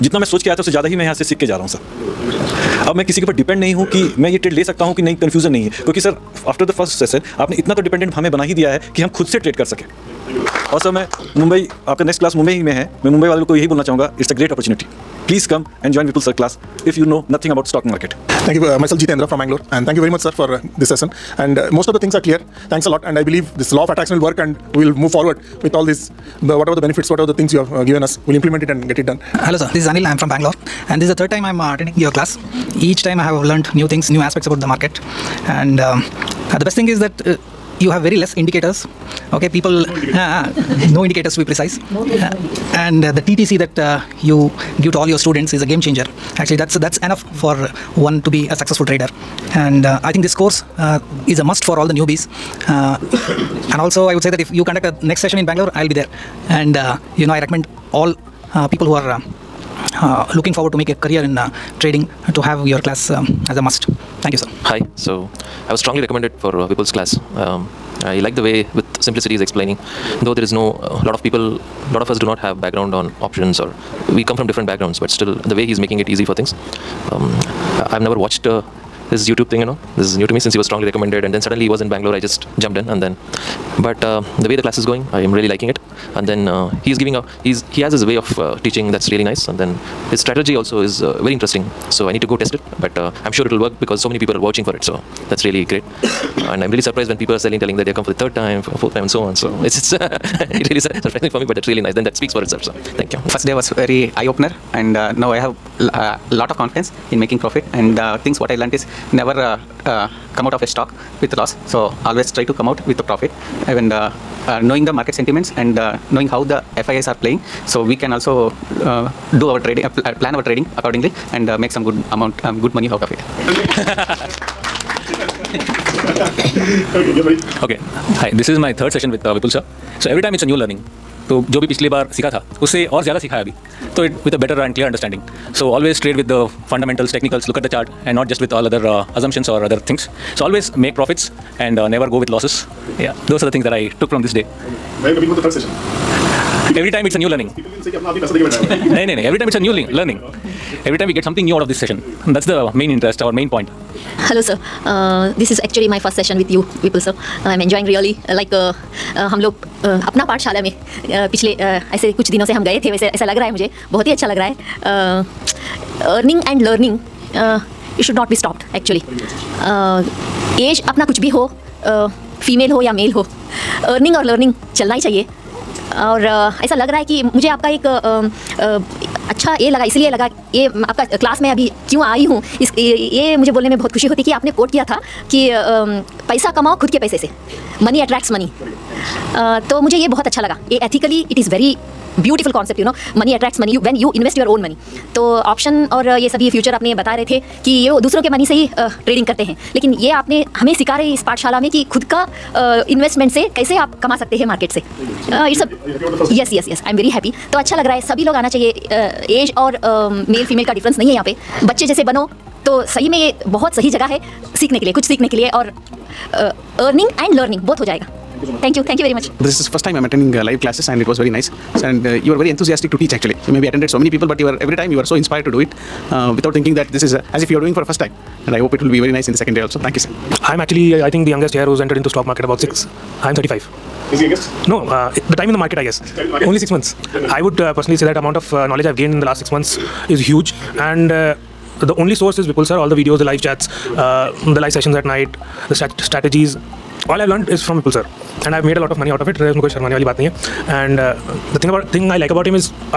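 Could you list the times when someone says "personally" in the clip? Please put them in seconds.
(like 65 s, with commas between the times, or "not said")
237 s.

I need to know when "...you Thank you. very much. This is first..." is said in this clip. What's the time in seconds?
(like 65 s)
218 s.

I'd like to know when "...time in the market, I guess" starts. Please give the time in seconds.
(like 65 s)
235 s.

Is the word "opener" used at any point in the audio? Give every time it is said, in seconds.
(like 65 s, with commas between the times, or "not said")
104 s.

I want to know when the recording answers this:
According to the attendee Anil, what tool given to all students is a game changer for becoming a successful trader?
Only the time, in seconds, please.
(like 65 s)
43 s.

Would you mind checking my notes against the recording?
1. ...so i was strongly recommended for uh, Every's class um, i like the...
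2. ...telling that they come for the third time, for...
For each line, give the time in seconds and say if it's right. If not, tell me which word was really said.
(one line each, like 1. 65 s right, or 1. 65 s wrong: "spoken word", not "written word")
1. 64 s wrong: "Vipul", not "Every"
2. 97 s right.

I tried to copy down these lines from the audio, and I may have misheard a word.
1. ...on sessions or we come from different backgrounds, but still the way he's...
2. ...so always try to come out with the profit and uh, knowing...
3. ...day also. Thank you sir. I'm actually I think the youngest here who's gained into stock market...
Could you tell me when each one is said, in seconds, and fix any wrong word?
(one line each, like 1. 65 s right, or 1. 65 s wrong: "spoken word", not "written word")
1. 72 s wrong: "options", not "sessions"
2. 111 s right
3. 229 s wrong: "entered", not "gained".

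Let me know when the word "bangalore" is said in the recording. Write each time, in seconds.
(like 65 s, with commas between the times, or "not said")
30 s, 55 s, 81 s.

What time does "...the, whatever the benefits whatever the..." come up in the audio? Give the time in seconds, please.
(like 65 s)
26 s.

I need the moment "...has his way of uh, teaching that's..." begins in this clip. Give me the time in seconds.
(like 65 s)
87 s.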